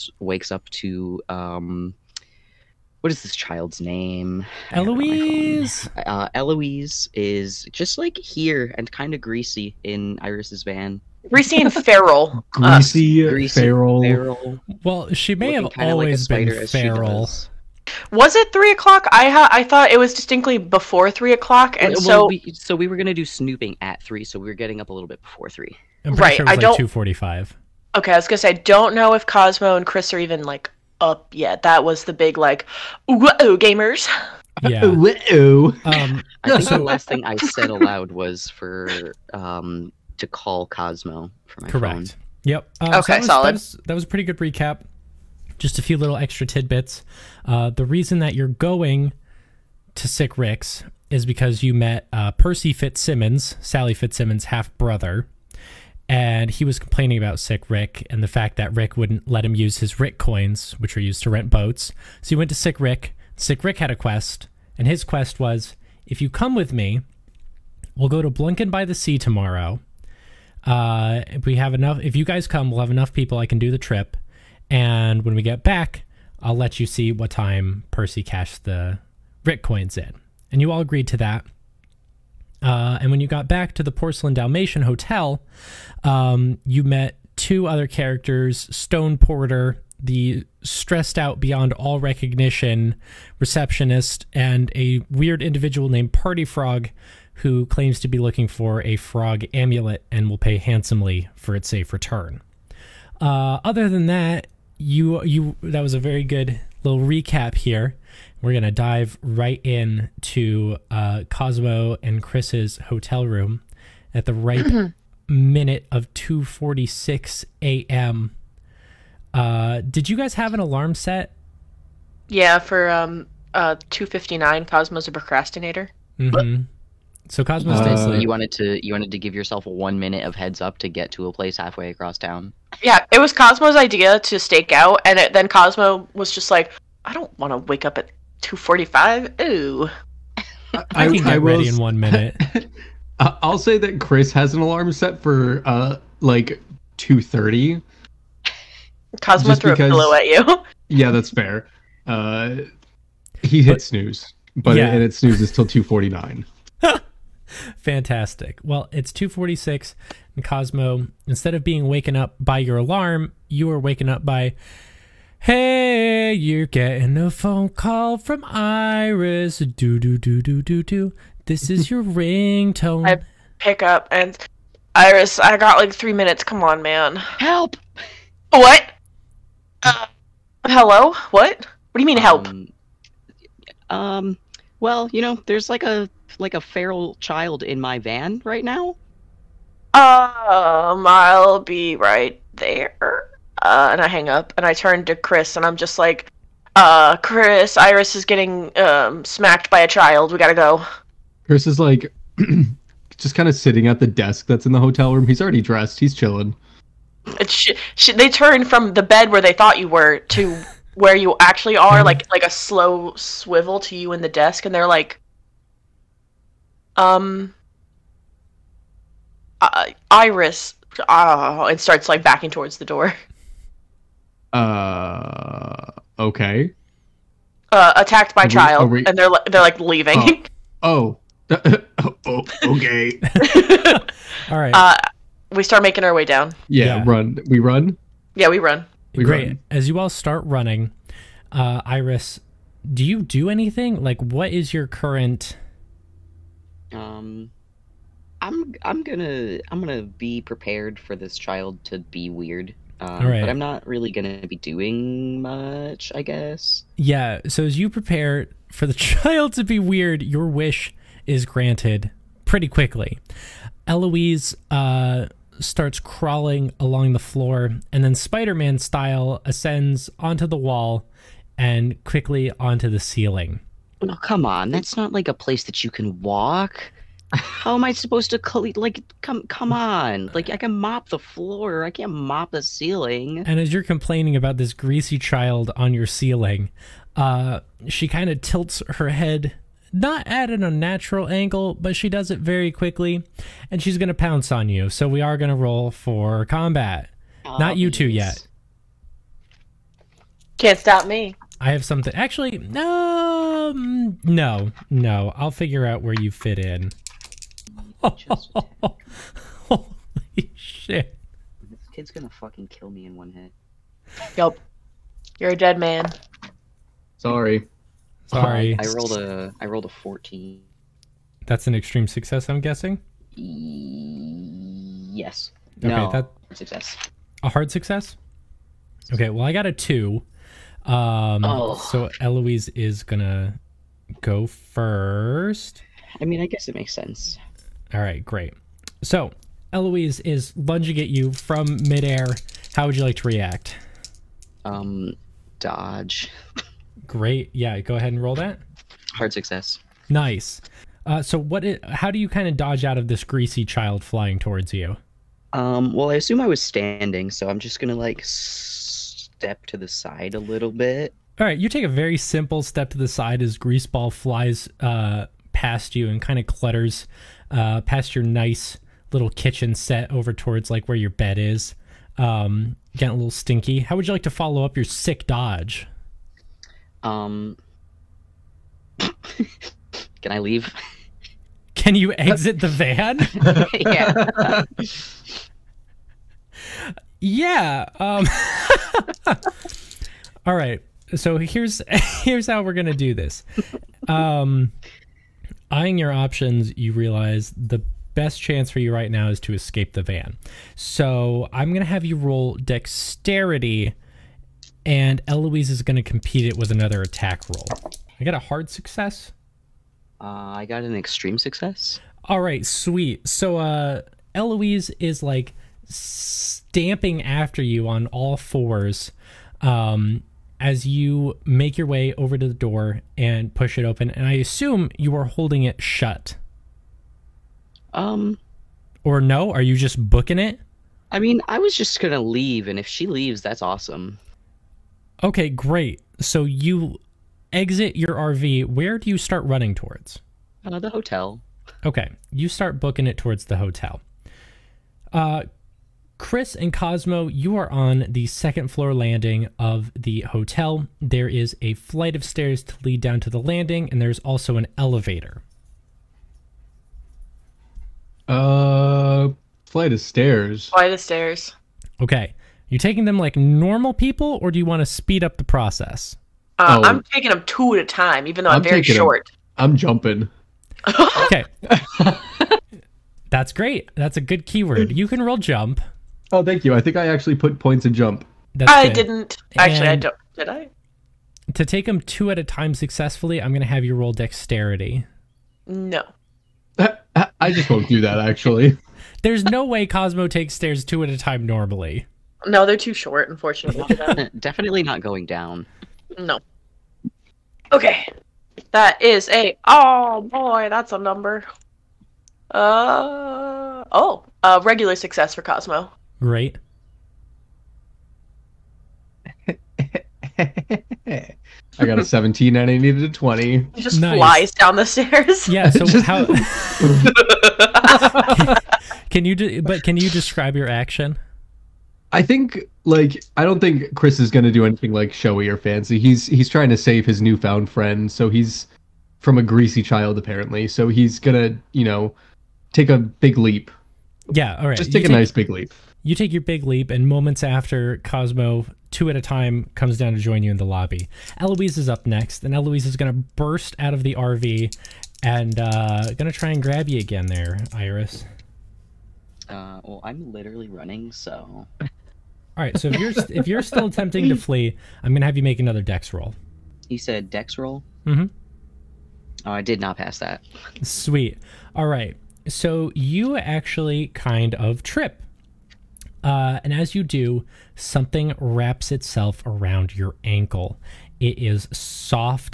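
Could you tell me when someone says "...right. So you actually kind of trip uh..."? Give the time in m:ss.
9:21.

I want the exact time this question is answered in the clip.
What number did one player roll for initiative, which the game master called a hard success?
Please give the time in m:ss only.
5:19.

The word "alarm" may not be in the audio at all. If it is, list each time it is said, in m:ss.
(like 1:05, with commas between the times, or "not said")
2:00, 2:24, 2:42.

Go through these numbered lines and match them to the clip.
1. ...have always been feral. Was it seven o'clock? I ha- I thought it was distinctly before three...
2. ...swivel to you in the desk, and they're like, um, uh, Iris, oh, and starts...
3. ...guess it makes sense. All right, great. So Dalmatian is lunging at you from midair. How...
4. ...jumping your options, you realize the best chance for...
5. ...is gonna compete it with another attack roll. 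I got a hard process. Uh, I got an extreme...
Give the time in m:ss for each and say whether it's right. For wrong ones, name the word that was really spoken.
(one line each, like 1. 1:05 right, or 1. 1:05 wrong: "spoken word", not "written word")
1. 0:15 wrong: "three", not "seven"
2. 3:33 right
3. 5:36 wrong: "Eloise", not "Dalmatian"
4. 6:35 wrong: "eyeing", not "jumping"
5. 6:45 wrong: "success", not "process".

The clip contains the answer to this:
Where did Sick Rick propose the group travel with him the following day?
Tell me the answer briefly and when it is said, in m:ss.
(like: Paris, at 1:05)
Blunken by the Sea, at 1:08.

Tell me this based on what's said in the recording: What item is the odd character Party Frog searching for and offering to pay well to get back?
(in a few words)
frog amulet.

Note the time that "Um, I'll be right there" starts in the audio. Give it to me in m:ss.
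3:09.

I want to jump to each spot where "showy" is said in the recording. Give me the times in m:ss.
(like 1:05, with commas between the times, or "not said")
8:45.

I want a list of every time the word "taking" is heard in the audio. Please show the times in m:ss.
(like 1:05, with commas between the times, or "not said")
7:42, 7:47.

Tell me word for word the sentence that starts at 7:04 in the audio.
And I assume you are holding it shut.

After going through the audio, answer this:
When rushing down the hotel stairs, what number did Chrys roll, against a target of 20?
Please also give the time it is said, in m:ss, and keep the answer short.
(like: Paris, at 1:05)
17, at 8:32.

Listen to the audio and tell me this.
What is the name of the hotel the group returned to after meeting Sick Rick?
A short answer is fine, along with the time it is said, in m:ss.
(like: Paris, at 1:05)
Porcelain Dalmatian Hotel, at 1:23.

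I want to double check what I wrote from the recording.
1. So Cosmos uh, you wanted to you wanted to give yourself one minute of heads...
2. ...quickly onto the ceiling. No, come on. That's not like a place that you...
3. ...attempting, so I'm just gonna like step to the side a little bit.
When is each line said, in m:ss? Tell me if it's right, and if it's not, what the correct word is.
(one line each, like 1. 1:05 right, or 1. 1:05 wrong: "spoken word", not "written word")
1. 2:07 right
2. 4:32 right
3. 5:56 wrong: "standing", not "attempting".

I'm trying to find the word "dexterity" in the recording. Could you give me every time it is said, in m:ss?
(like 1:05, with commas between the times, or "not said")
6:42, 8:04.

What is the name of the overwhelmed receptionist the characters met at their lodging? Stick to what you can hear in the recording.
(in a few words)
Stone Porter.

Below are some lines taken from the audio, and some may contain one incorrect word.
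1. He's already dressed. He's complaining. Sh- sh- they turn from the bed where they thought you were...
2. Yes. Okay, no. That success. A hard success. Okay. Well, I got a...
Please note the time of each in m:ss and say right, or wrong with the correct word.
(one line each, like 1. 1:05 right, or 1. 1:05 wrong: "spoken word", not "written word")
1. 3:25 wrong: "chilling", not "complaining"
2. 5:23 right.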